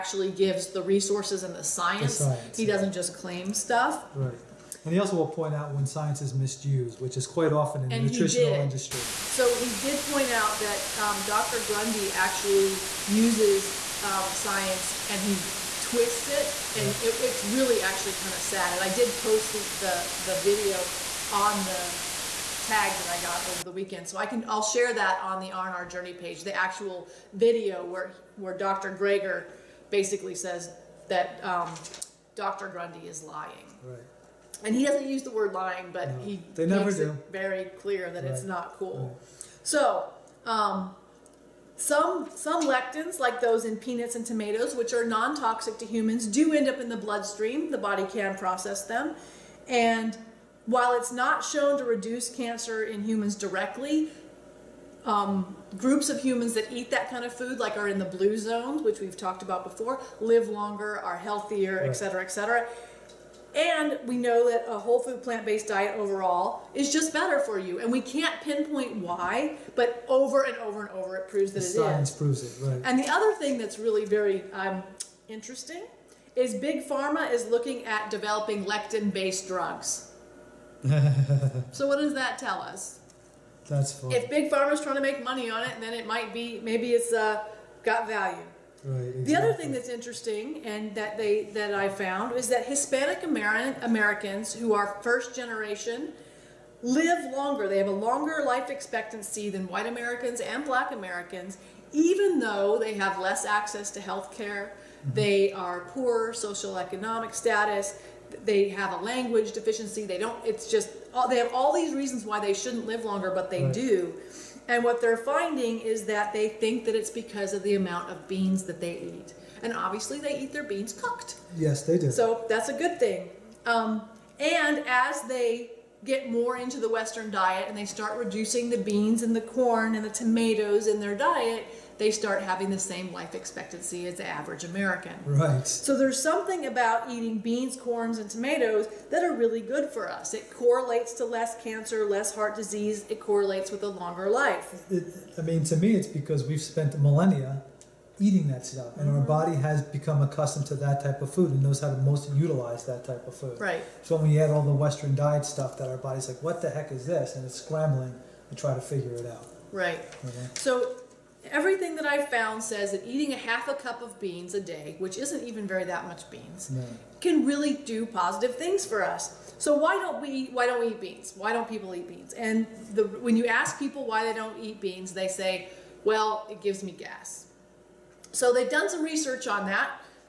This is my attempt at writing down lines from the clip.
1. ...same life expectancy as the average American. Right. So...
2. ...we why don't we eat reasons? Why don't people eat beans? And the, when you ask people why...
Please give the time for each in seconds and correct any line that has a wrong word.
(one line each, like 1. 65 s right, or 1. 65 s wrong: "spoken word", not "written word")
1. 132 s right
2. 170 s wrong: "beans", not "reasons".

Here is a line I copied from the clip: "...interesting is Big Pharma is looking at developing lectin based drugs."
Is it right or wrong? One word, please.
right.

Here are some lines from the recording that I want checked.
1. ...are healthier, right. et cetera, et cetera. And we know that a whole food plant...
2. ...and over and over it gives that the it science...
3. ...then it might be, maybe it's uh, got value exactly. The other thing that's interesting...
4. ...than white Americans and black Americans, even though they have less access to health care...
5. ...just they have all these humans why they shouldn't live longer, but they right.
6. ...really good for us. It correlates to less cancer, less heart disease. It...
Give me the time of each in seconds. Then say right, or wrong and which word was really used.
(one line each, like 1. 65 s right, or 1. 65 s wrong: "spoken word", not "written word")
1. 60 s right
2. 70 s wrong: "proves", not "gives"
3. 85 s right
4. 99 s right
5. 110 s wrong: "reasons", not "humans"
6. 139 s right.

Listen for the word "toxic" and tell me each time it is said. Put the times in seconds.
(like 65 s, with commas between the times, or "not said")
45 s.